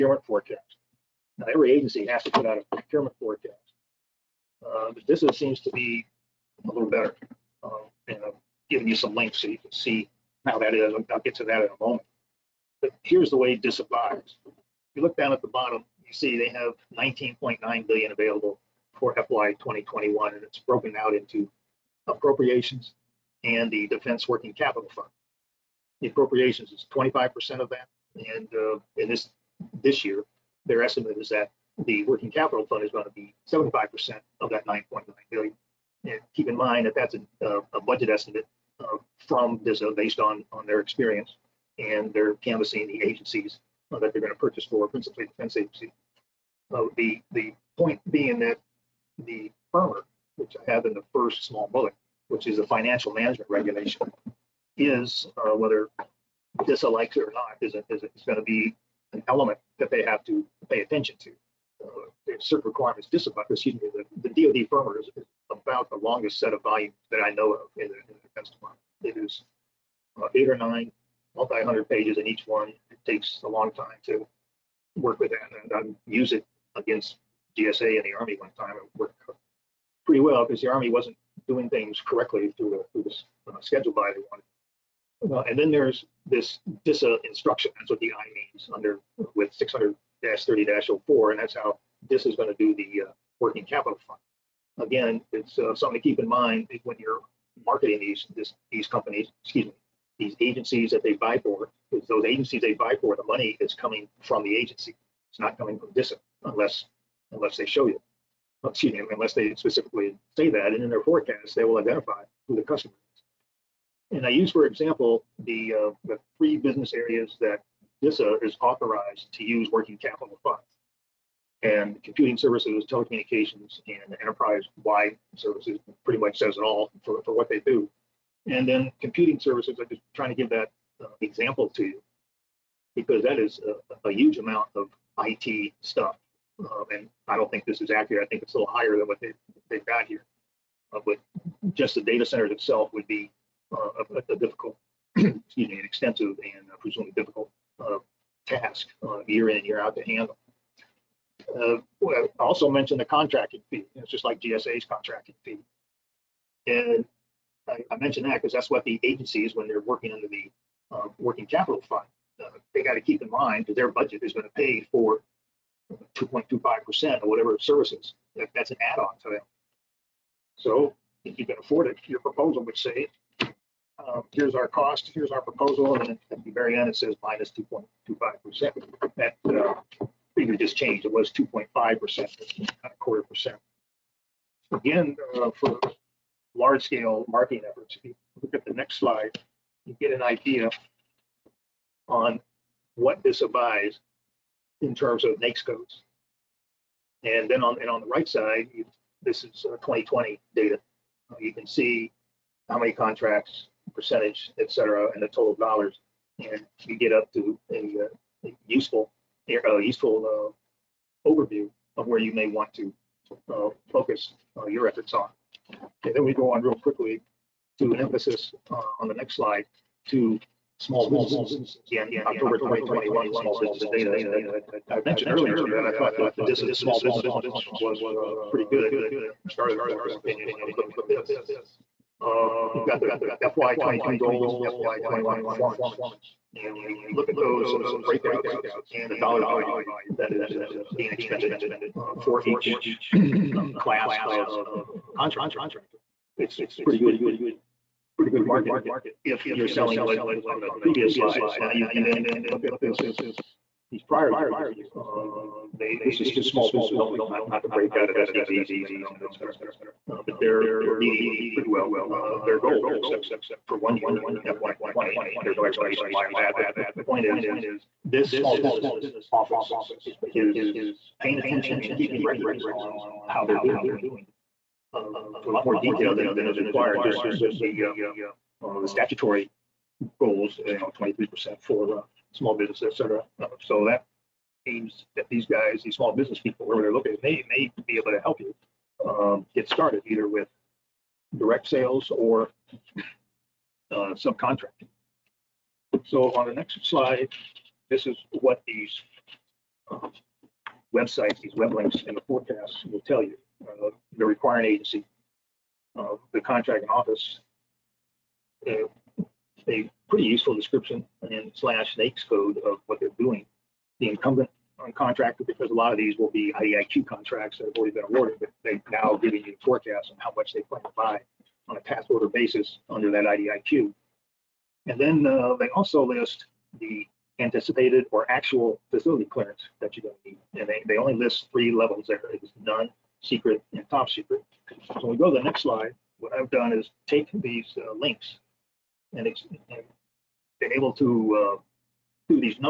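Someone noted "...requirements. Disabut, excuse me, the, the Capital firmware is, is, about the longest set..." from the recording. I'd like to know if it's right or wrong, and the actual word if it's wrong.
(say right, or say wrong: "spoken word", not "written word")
wrong: "DoD", not "Capital".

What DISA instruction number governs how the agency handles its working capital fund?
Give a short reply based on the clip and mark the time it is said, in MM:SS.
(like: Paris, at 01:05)
600-30-04, at 01:30.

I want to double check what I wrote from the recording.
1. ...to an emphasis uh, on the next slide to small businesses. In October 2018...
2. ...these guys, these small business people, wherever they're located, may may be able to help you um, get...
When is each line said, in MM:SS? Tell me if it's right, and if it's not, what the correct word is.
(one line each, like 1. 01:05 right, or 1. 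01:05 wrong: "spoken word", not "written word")
1. 03:37 wrong: "2021", not "2018"
2. 04:45 right.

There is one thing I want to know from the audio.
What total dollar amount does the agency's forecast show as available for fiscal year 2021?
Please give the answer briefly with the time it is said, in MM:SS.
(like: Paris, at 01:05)
19.9 billion, at 00:16.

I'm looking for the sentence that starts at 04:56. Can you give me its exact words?
So on the next slide, this is what these uh, websites, these web links and the forecasts will tell you.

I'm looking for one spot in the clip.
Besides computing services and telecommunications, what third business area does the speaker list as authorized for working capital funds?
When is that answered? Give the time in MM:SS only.
02:04.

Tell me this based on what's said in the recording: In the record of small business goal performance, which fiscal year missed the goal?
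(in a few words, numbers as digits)
FY20.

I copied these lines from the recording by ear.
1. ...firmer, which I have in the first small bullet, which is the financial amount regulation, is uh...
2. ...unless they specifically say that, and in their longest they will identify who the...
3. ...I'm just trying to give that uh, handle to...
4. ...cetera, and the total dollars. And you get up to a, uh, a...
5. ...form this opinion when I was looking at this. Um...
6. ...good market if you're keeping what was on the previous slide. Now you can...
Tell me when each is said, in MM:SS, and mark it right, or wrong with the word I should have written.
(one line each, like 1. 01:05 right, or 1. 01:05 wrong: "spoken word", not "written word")
1. 00:49 wrong: "management", not "amount"
2. 01:49 wrong: "forecast", not "longest"
3. 02:09 wrong: "example", not "handle"
4. 03:24 right
5. 03:49 right
6. 04:08 wrong: "selling", not "keeping".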